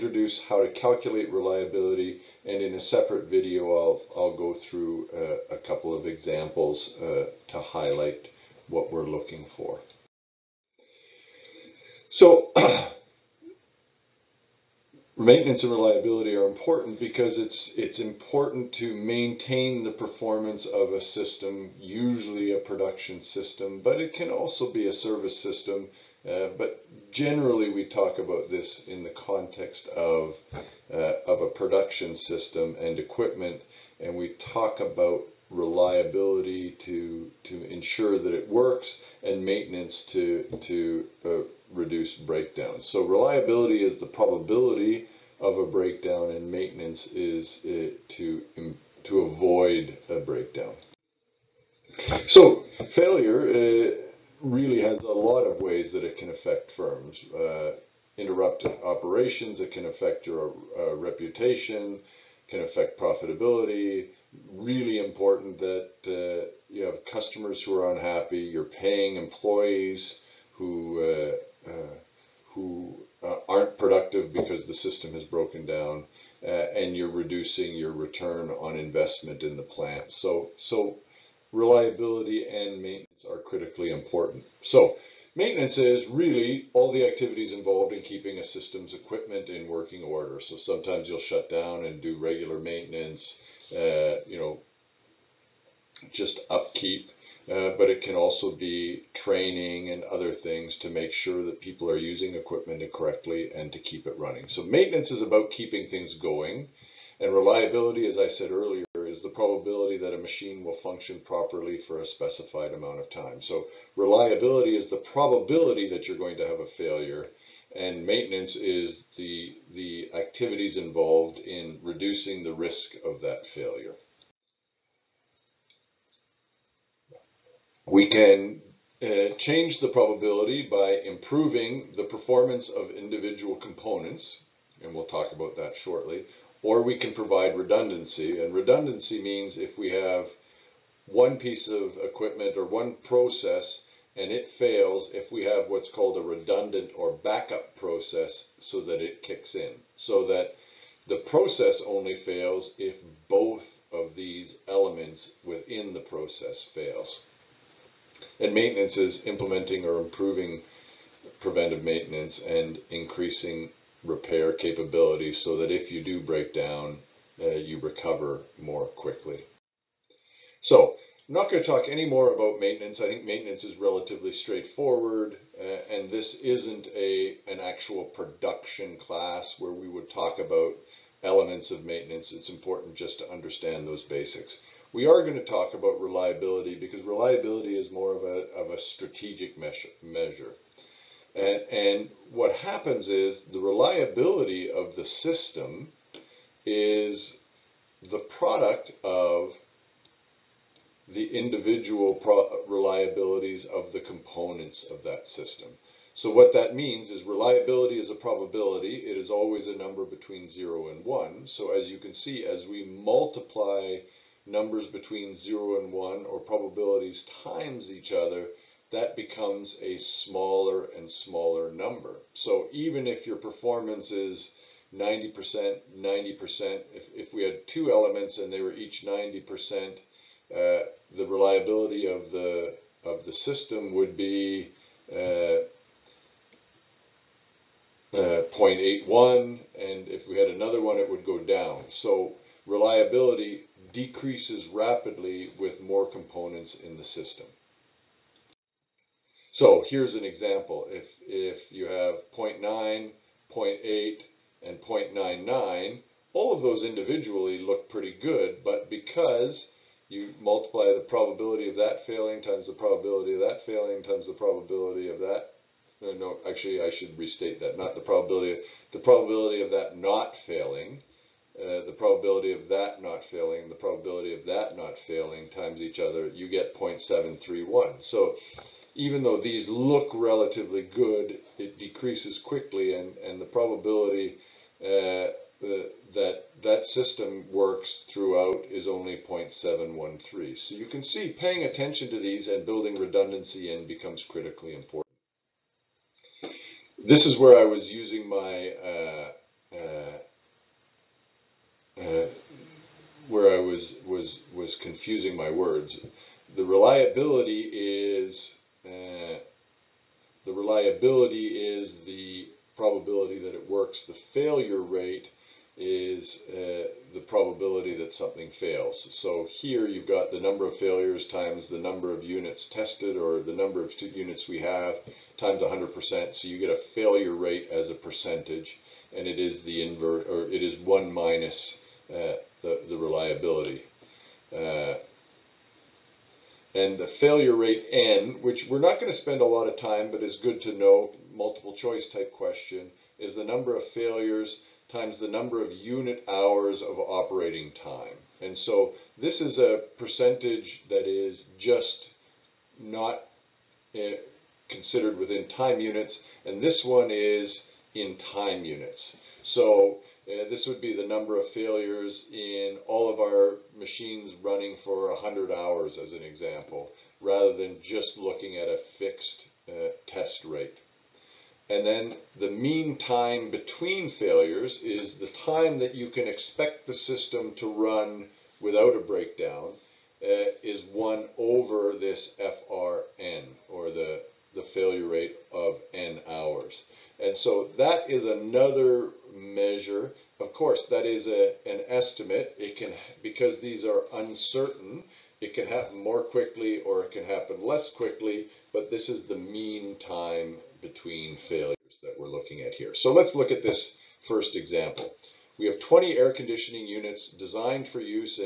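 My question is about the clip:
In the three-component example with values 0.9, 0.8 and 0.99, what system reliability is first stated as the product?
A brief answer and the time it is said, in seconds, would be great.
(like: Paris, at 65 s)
0.731, at 276 s.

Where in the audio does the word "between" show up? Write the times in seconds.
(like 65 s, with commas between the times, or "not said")
210 s, 214 s, 373 s, 400 s.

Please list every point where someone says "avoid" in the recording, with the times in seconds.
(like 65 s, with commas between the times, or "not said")
49 s.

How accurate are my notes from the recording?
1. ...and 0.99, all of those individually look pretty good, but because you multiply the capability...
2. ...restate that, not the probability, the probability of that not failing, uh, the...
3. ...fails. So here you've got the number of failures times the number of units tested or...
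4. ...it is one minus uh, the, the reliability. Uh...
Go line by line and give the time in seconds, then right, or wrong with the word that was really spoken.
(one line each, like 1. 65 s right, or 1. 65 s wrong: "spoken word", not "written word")
1. 254 s wrong: "probability", not "capability"
2. 267 s right
3. 318 s right
4. 330 s right.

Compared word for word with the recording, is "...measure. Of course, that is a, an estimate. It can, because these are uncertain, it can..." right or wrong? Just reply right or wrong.
right.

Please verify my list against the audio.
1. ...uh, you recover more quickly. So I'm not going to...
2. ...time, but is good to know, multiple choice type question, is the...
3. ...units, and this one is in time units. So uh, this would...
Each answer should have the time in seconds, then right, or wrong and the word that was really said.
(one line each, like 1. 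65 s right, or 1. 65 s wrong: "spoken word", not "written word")
1. 167 s right
2. 339 s right
3. 355 s right.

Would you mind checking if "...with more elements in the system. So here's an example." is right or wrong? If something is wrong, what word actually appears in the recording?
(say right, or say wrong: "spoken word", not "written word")
wrong: "components", not "elements".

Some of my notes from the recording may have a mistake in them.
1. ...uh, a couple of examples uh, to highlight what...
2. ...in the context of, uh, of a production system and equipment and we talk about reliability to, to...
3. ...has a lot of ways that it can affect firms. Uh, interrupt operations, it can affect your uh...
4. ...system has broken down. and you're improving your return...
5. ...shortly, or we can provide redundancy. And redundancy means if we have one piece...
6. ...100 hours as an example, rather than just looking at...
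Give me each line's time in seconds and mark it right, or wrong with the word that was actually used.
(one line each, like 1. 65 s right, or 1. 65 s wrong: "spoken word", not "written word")
1. 5 s right
2. 28 s right
3. 54 s right
4. 74 s wrong: "reducing", not "improving"
5. 135 s right
6. 365 s right.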